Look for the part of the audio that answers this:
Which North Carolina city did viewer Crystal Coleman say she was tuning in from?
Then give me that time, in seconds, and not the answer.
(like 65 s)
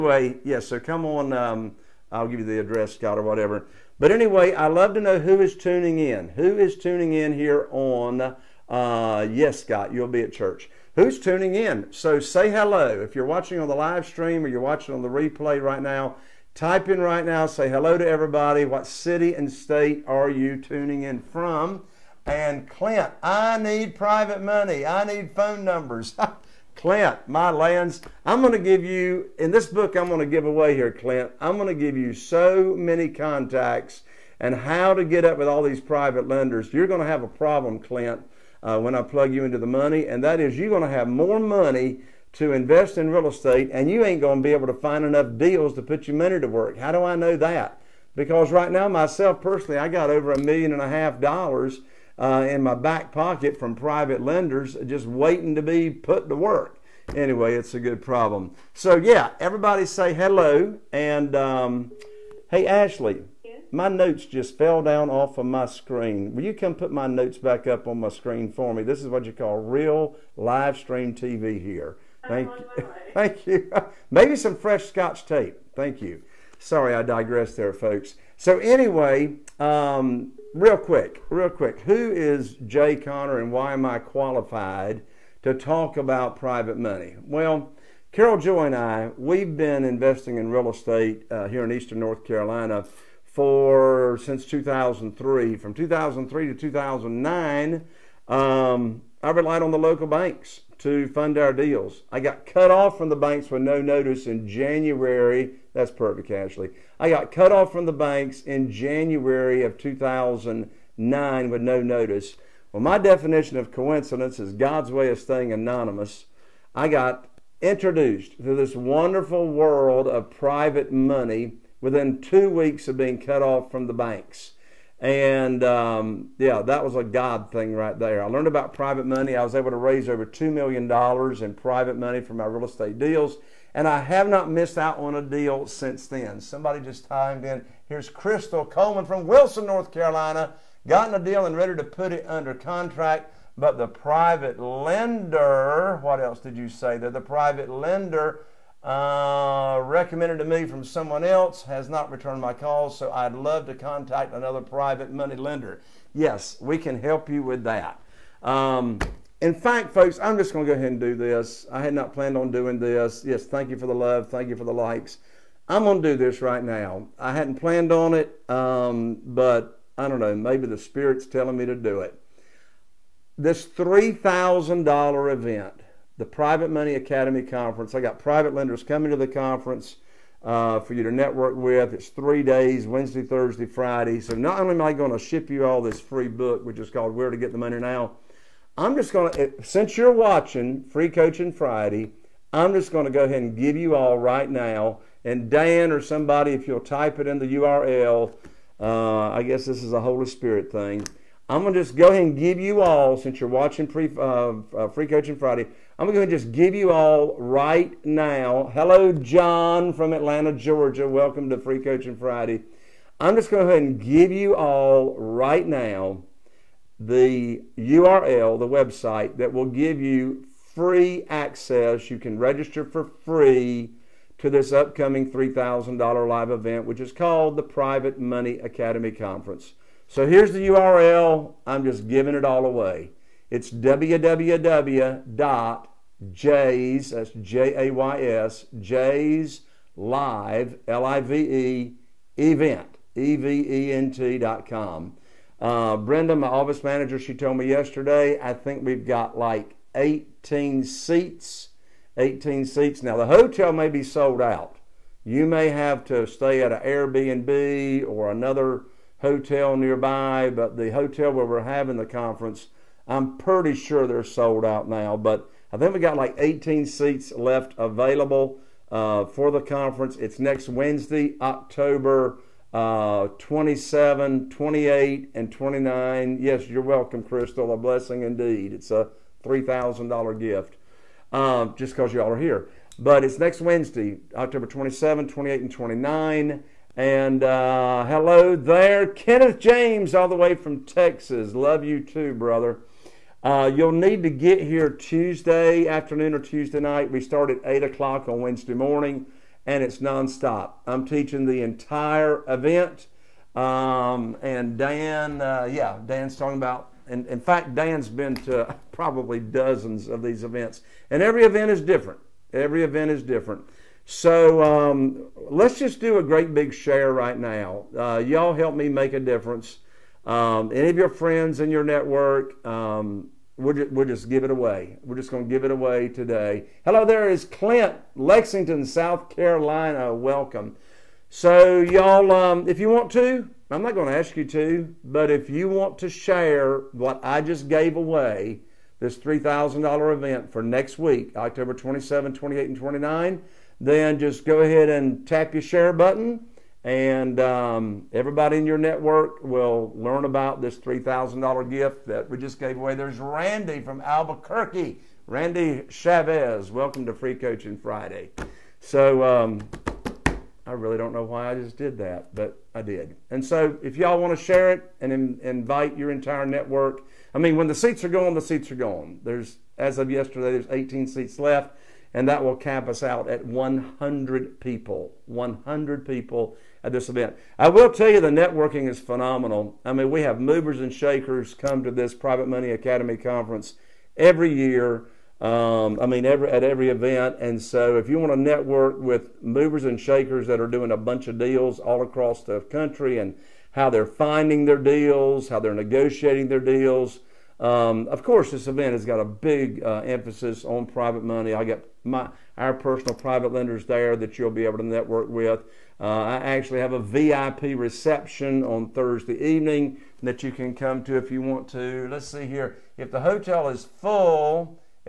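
139 s.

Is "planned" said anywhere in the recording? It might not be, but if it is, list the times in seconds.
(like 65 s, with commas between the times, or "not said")
162 s, 167 s.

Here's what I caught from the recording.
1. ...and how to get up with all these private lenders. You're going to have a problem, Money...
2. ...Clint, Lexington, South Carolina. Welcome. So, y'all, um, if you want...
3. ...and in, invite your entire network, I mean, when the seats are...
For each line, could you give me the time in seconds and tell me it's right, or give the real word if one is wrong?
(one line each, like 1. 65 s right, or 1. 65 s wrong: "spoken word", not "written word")
1. 34 s wrong: "Clint", not "Money"
2. 327 s right
3. 365 s right.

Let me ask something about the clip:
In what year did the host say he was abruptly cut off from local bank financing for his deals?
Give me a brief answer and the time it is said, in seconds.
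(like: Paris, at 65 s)
2009, at 108 s.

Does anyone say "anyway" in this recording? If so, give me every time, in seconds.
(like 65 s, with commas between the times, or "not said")
4 s, 57 s, 78 s.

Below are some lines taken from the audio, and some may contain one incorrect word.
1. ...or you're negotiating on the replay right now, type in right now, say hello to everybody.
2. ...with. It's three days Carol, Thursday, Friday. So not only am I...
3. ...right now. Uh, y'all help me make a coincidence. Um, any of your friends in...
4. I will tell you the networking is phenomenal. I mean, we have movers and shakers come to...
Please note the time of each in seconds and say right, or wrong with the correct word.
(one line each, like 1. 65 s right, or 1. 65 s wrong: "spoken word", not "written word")
1. 14 s wrong: "watching", not "negotiating"
2. 181 s wrong: "Wednesday", not "Carol"
3. 317 s wrong: "difference", not "coincidence"
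4. 377 s right.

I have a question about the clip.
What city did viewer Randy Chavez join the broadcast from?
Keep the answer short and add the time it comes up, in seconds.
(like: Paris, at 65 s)
Albuquerque, at 354 s.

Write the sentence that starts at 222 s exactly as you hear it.
You can register for free to this upcoming $3,000 live event, which is called the Private Money Academy Conference.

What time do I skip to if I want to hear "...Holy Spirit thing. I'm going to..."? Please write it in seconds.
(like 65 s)
200 s.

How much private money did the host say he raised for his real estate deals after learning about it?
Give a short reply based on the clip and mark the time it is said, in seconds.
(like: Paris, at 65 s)
over $2 million, at 130 s.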